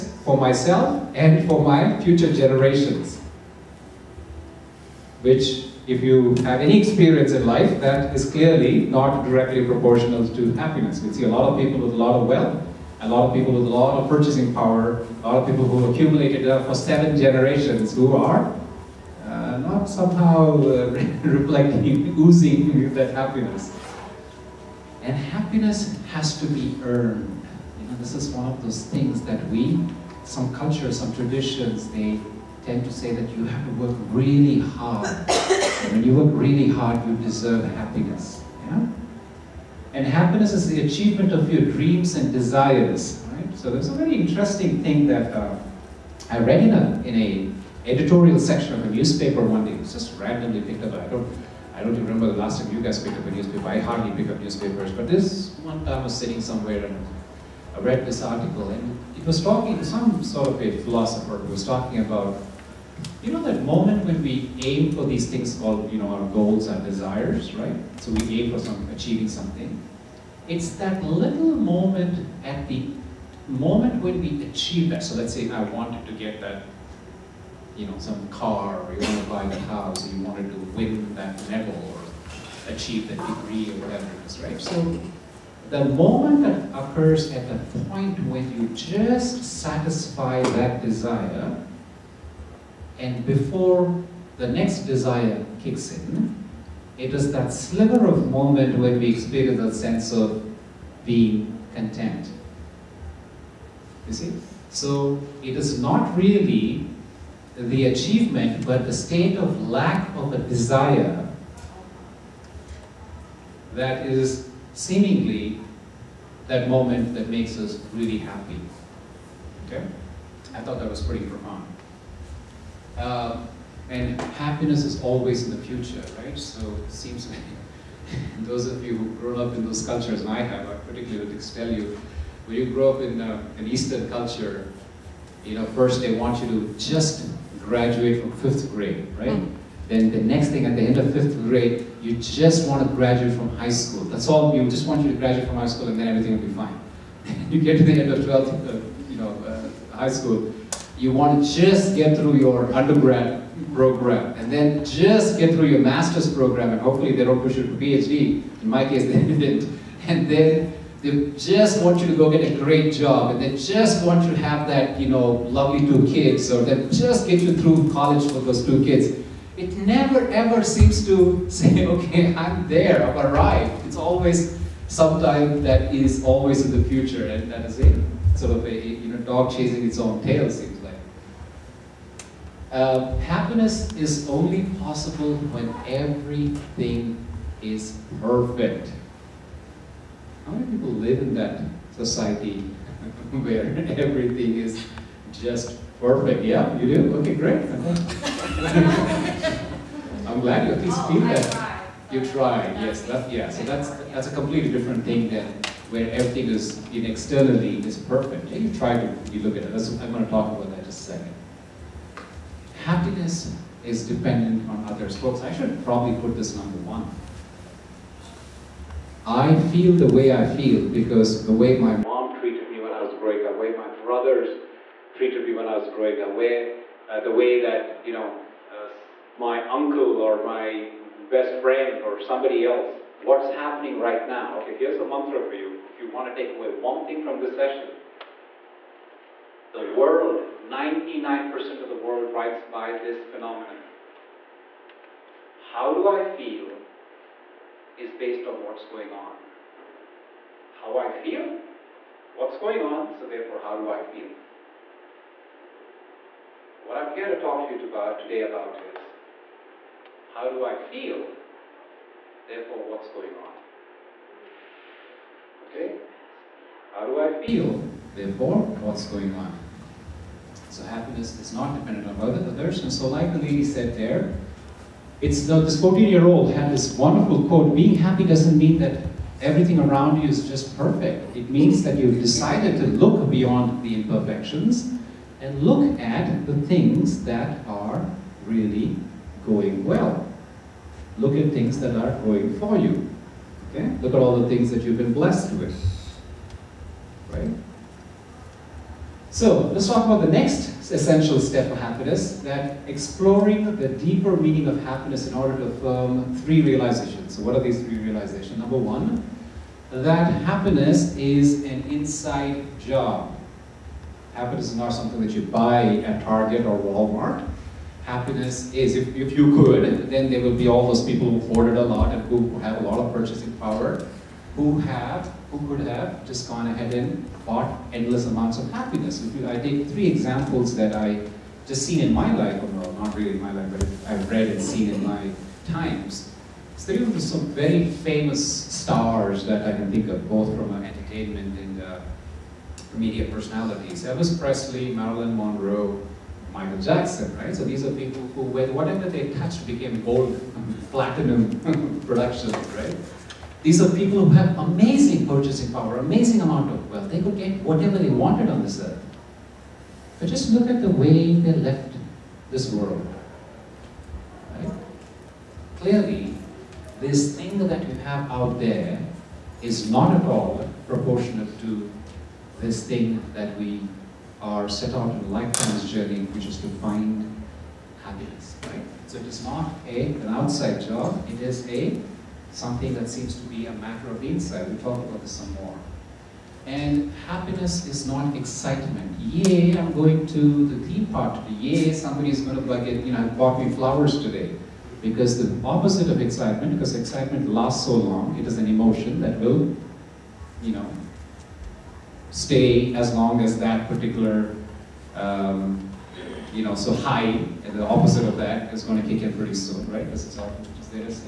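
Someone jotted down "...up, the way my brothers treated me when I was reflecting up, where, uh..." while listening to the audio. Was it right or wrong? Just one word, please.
wrong.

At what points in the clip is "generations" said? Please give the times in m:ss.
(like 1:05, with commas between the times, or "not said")
0:02, 0:17.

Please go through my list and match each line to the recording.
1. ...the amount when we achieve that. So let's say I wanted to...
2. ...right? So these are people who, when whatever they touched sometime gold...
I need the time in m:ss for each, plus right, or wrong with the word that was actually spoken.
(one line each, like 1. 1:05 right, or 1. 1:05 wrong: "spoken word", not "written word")
1. 1:12 wrong: "moment", not "amount"
2. 5:47 wrong: "became", not "sometime".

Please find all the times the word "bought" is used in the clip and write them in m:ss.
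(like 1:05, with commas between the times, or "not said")
5:27, 6:33.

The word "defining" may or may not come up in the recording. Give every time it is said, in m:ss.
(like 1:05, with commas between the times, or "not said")
not said.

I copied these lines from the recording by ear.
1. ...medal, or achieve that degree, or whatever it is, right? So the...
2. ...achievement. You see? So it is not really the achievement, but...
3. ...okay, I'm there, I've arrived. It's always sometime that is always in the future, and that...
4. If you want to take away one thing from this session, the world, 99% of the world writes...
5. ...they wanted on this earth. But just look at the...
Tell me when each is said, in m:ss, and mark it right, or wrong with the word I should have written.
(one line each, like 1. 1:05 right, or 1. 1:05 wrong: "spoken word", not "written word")
1. 1:21 right
2. 1:41 wrong: "content", not "achievement"
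3. 2:51 right
4. 3:55 right
5. 5:57 right.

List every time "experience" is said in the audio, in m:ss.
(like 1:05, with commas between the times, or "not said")
0:06, 1:39.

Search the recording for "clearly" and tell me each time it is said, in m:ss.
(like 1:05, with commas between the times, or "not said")
0:08, 6:05.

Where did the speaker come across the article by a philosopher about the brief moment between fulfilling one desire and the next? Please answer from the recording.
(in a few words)
Editorial section of a newspaper.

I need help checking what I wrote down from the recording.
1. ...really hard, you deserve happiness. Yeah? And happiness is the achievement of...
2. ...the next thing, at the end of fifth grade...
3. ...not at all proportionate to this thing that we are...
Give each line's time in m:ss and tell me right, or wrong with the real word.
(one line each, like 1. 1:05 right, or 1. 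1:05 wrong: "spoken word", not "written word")
1. 0:36 right
2. 2:20 right
3. 6:09 right.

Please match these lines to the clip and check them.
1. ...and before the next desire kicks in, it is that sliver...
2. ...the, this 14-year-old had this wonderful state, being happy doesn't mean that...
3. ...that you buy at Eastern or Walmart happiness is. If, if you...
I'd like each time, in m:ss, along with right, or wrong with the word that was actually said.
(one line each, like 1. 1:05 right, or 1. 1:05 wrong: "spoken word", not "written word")
1. 1:32 right
2. 4:35 wrong: "quote", not "state"
3. 5:15 wrong: "Target", not "Eastern".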